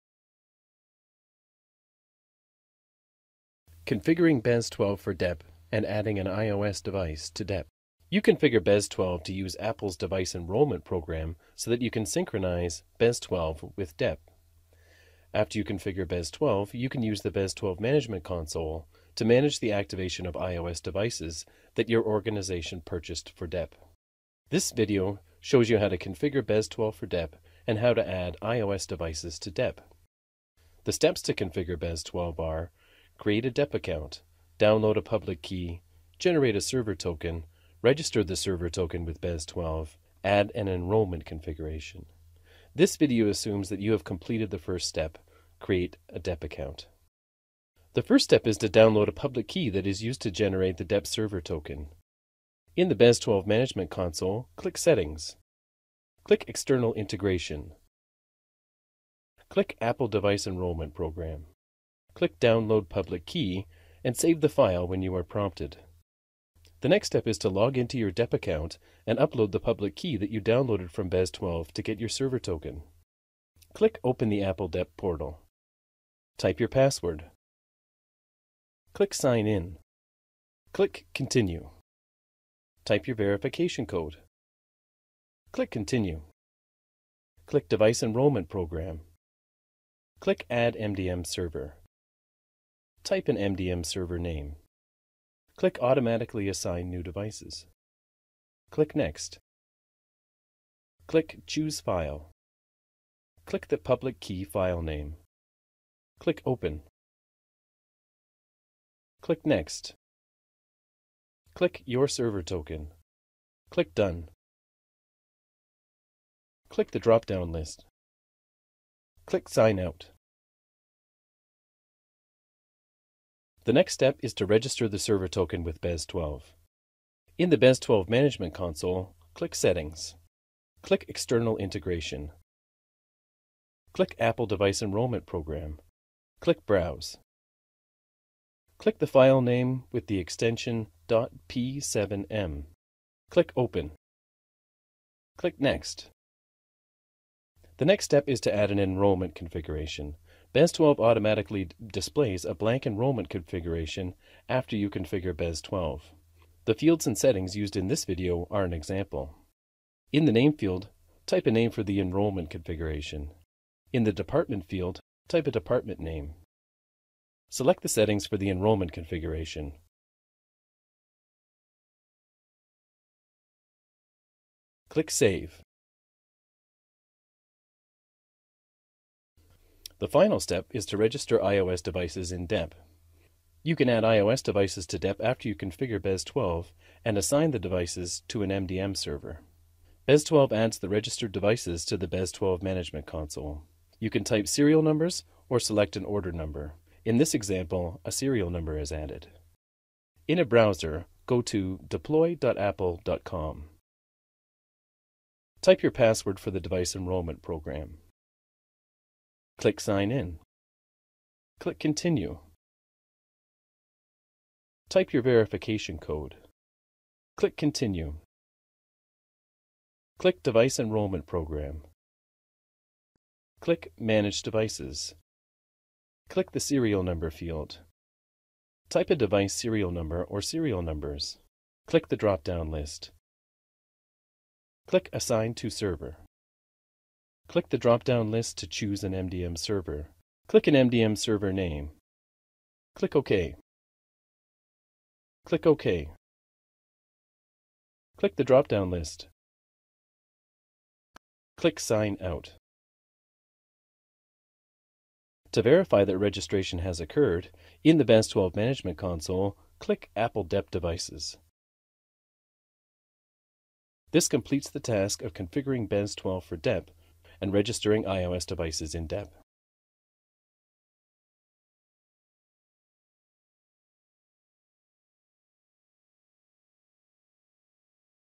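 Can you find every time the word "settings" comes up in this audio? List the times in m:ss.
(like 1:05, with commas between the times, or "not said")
0:54, 2:09, 2:37, 2:47.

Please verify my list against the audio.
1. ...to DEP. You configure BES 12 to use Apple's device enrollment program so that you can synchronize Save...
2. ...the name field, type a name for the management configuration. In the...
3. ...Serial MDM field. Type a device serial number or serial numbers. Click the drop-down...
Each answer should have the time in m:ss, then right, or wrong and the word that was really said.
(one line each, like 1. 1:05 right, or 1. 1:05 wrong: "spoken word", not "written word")
1. 0:07 wrong: "BES", not "Save"
2. 2:40 wrong: "enrollment", not "management"
3. 3:46 wrong: "Number", not "MDM".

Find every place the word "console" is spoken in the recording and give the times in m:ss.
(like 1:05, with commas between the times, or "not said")
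0:18, 0:53, 2:08, 3:13, 4:18.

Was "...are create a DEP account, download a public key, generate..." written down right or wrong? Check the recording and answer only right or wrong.
right.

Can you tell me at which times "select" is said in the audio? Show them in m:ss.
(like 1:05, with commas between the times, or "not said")
2:47, 3:15.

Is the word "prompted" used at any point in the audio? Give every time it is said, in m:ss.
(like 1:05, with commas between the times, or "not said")
1:05.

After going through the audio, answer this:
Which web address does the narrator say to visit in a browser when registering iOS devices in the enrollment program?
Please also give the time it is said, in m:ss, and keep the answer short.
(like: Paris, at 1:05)
deploy.apple.com, at 3:21.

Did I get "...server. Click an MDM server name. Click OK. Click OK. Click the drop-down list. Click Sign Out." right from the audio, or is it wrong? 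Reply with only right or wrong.
right.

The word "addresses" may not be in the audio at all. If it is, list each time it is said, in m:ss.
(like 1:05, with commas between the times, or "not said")
not said.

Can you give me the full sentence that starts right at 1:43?
Click the public key file name.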